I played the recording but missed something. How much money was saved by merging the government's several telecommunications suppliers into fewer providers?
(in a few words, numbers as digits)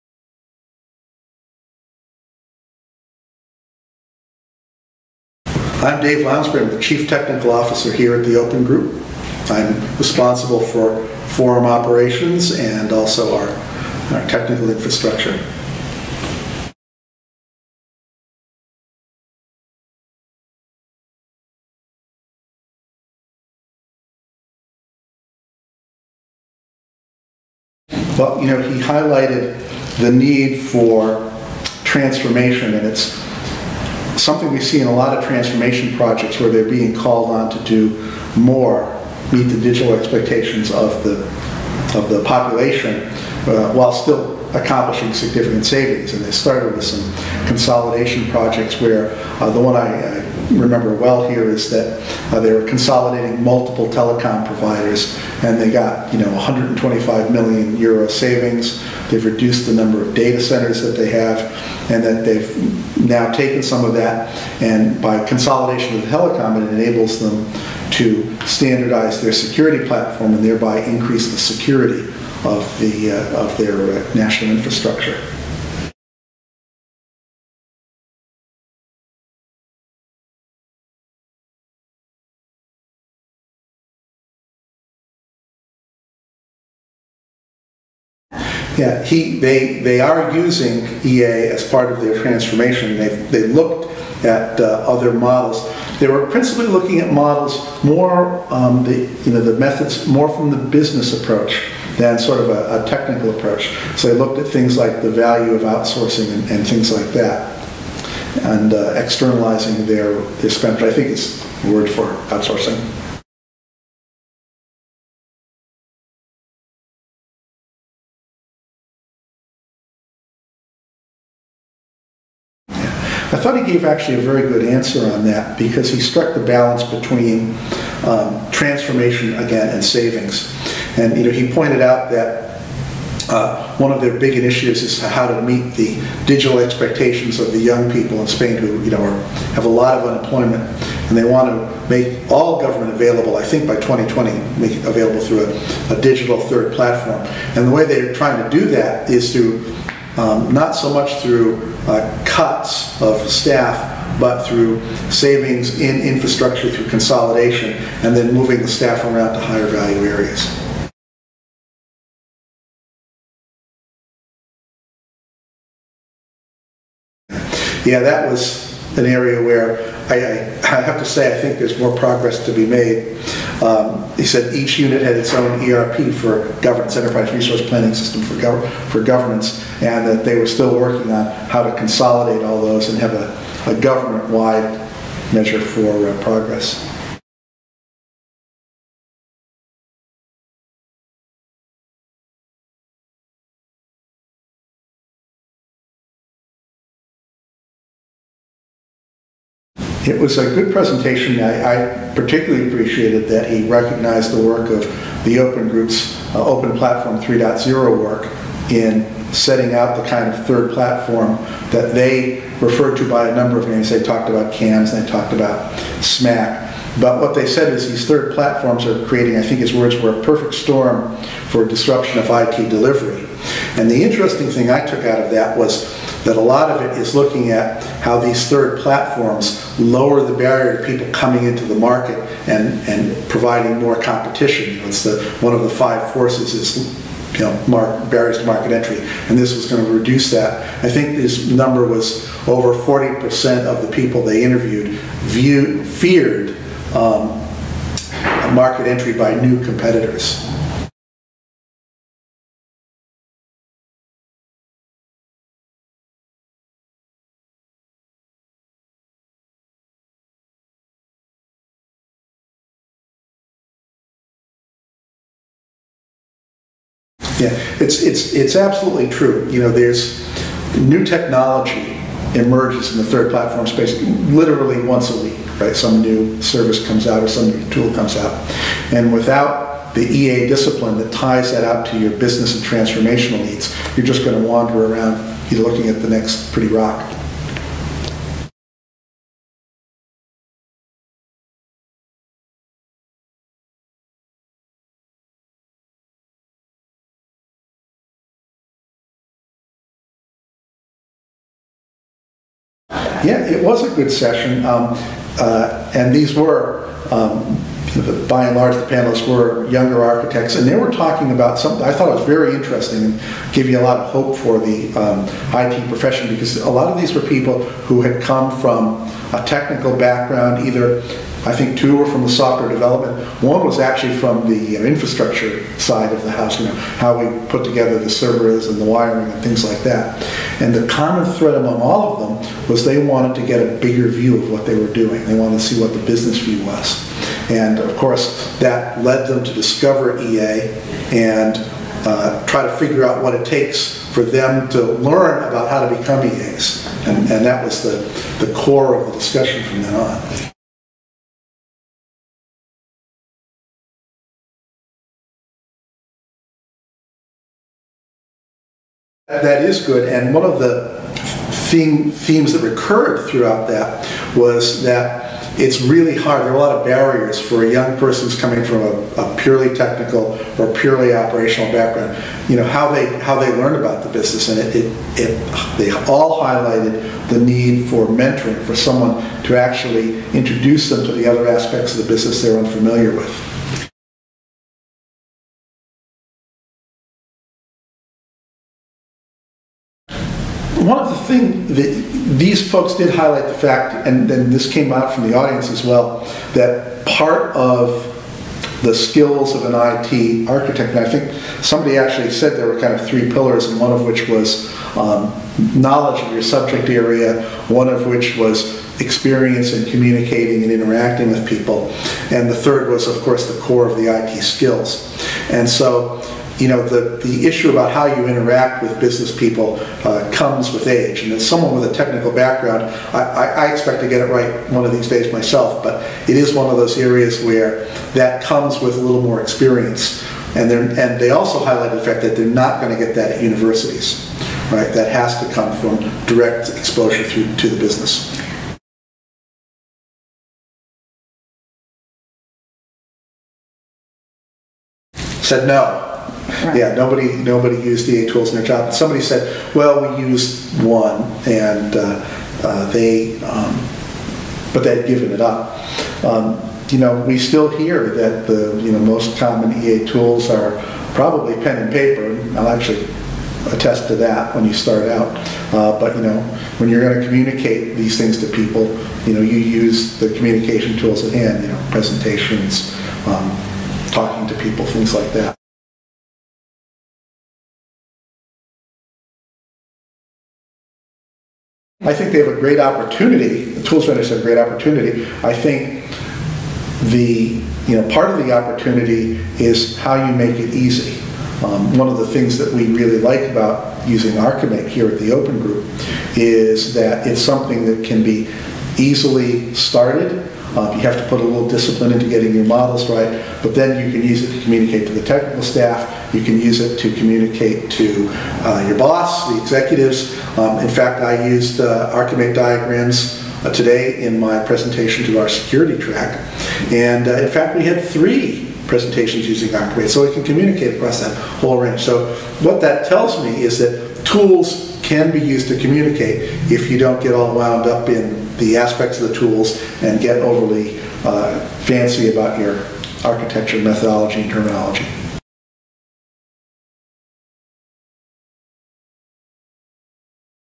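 125 million euro.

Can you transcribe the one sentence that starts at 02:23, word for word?
I think by 2020, make it available through a, a digital third platform.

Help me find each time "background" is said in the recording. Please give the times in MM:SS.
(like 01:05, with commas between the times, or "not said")
05:19, 06:11, 07:02.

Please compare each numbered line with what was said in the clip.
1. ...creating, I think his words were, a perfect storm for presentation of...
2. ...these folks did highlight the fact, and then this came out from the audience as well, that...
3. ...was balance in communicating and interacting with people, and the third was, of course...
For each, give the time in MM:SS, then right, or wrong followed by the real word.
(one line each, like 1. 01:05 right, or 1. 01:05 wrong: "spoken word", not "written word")
1. 03:39 wrong: "disruption", not "presentation"
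2. 06:32 right
3. 06:48 wrong: "experience", not "balance".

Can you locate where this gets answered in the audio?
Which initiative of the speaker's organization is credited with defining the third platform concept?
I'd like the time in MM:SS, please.
03:26.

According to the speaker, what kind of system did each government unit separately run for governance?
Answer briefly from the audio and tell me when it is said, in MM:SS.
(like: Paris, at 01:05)
ERP, at 02:55.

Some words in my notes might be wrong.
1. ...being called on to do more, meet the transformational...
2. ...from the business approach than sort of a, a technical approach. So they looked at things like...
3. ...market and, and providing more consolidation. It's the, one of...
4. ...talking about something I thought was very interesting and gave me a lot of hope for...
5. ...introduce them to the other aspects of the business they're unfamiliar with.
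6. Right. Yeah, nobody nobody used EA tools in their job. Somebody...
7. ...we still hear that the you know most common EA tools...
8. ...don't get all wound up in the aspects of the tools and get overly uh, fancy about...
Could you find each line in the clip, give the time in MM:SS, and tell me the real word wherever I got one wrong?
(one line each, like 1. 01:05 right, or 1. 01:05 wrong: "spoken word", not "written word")
1. 00:36 wrong: "digital", not "transformational"
2. 01:40 right
3. 03:51 wrong: "competition", not "consolidation"
4. 05:10 right
5. 06:20 right
6. 07:26 right
7. 07:37 right
8. 08:46 right.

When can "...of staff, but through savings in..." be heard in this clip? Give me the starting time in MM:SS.
02:33.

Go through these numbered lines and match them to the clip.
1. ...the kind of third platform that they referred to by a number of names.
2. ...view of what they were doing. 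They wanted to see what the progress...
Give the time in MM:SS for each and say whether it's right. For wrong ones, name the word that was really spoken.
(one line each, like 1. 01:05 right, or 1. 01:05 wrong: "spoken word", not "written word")
1. 03:30 right
2. 05:34 wrong: "business", not "progress".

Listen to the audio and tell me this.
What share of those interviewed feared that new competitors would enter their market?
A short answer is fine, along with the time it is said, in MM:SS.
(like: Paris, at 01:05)
over 40%, at 04:02.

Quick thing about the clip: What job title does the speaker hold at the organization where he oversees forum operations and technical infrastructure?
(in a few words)
Chief Technical Officer.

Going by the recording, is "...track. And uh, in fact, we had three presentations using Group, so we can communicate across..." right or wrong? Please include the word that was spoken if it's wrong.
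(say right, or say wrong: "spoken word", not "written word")
wrong: "Archimate", not "Group".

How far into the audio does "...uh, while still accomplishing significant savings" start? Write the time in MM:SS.
00:43.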